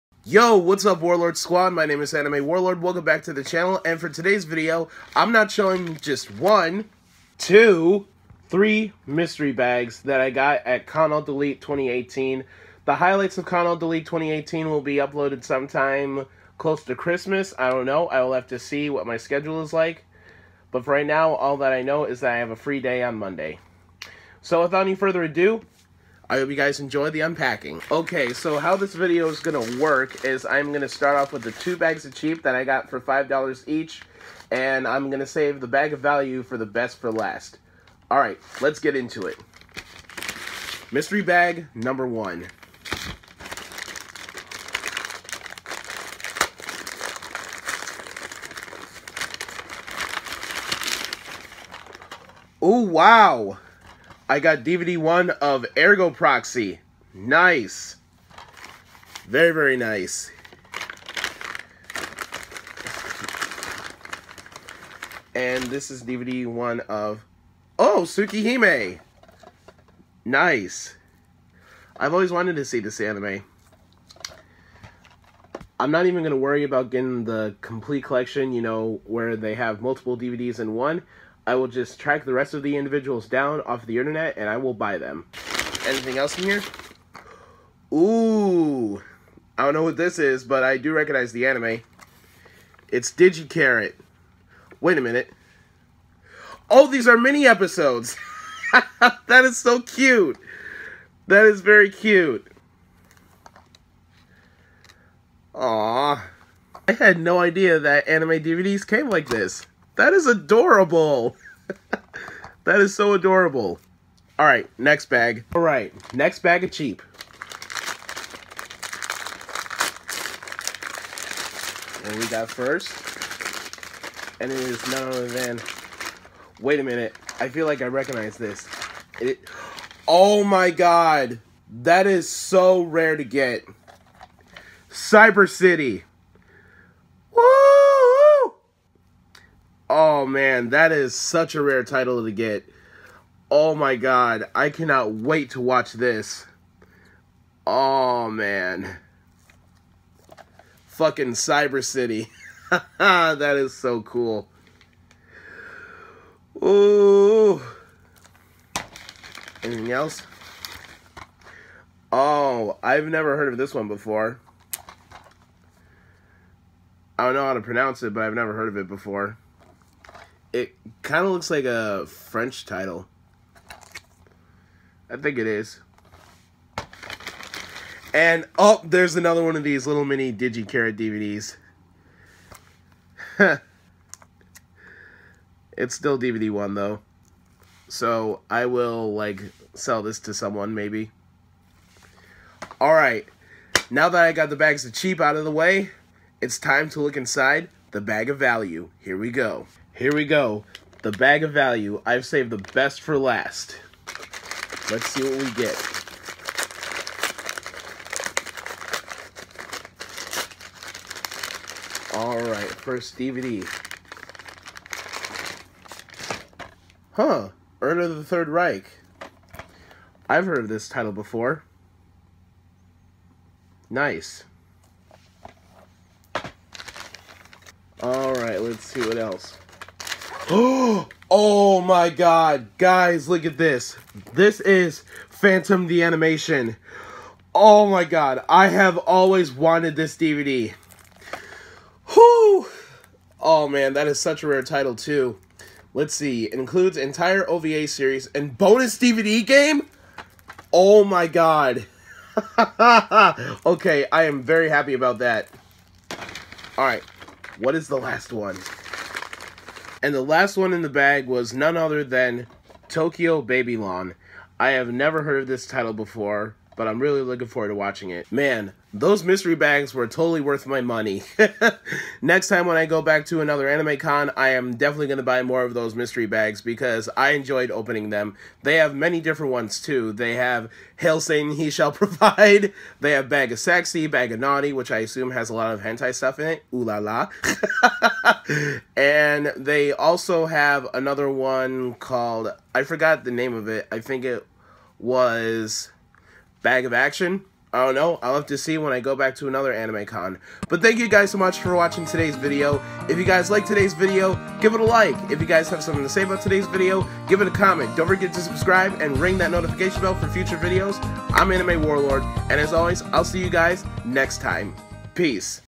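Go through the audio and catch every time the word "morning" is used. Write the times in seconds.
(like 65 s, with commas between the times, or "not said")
not said.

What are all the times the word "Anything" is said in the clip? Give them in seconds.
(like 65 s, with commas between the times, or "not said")
85 s, 159 s.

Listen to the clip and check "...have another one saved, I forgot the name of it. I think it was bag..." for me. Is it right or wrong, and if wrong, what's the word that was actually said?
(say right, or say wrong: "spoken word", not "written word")
wrong: "called", not "saved".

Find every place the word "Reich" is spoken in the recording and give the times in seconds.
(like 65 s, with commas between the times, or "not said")
218 s.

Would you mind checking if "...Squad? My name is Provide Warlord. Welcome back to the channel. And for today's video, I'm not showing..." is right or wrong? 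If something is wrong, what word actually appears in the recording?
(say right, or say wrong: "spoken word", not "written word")
wrong: "Anime", not "Provide".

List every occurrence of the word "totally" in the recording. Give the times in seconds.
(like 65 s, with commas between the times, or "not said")
270 s.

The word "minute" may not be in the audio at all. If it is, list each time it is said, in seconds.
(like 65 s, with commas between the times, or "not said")
95 s, 126 s.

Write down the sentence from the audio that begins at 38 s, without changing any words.
All right, let's get into it.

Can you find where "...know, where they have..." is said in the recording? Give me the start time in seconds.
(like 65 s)
78 s.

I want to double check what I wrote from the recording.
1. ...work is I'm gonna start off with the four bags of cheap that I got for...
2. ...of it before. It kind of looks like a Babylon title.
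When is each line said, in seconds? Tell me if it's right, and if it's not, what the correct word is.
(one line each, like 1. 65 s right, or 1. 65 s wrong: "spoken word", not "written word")
1. 29 s wrong: "two", not "four"
2. 168 s wrong: "French", not "Babylon".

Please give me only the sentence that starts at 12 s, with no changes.
The highlights of Con+Alt+Delete 2018 will be uploaded sometime close to Christmas.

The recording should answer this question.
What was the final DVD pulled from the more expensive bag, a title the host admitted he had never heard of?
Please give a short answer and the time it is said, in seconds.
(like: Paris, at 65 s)
Tokyo Babylon, at 262 s.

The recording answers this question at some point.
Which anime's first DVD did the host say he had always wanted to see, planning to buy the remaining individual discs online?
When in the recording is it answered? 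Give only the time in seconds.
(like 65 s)
68 s.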